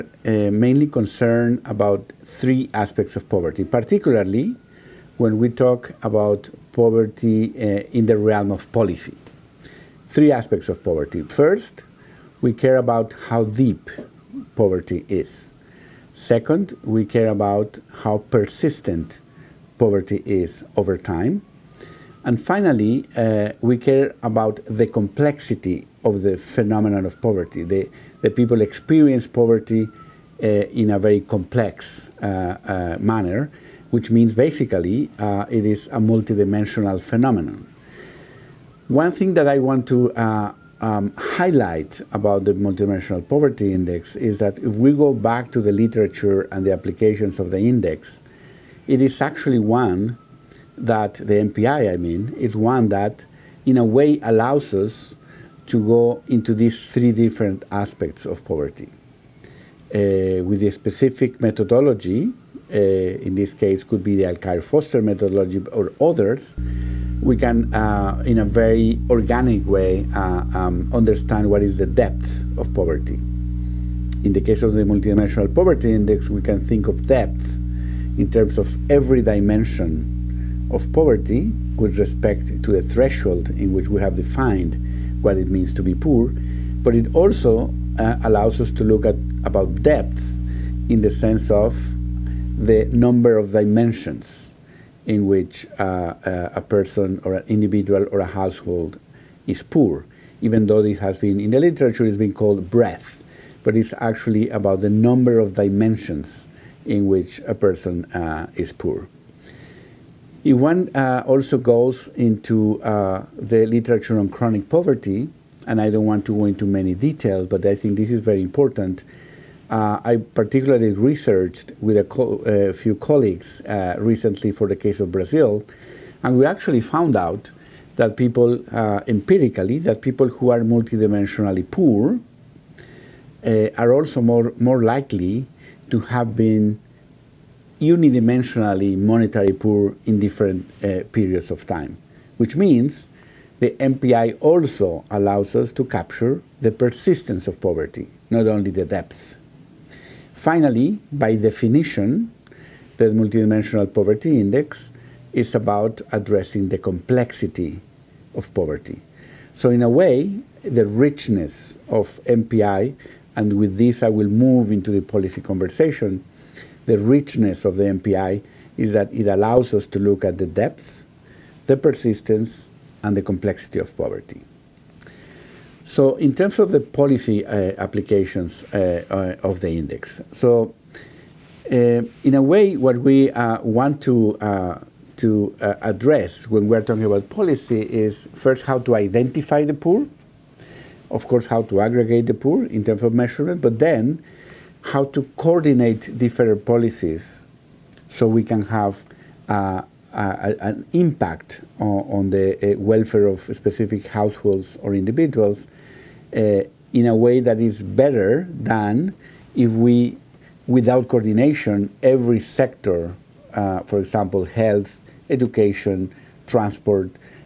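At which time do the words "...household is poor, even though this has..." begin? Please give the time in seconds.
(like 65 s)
98 s.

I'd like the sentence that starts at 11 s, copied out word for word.
First, we care about how deep poverty is.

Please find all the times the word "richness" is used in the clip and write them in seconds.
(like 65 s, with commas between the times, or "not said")
160 s, 166 s.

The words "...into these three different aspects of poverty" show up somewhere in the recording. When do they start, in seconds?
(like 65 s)
56 s.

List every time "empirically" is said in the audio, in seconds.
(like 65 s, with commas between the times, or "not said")
129 s.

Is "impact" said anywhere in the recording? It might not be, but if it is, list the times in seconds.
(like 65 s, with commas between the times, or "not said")
200 s.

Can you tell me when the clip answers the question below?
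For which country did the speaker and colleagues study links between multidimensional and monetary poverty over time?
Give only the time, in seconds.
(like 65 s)
125 s.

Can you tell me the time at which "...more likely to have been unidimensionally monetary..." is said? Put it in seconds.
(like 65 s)
134 s.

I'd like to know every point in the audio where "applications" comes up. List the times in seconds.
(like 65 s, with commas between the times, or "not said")
46 s, 177 s.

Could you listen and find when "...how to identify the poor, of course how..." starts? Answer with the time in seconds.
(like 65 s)
188 s.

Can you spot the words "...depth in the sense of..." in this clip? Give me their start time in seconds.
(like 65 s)
89 s.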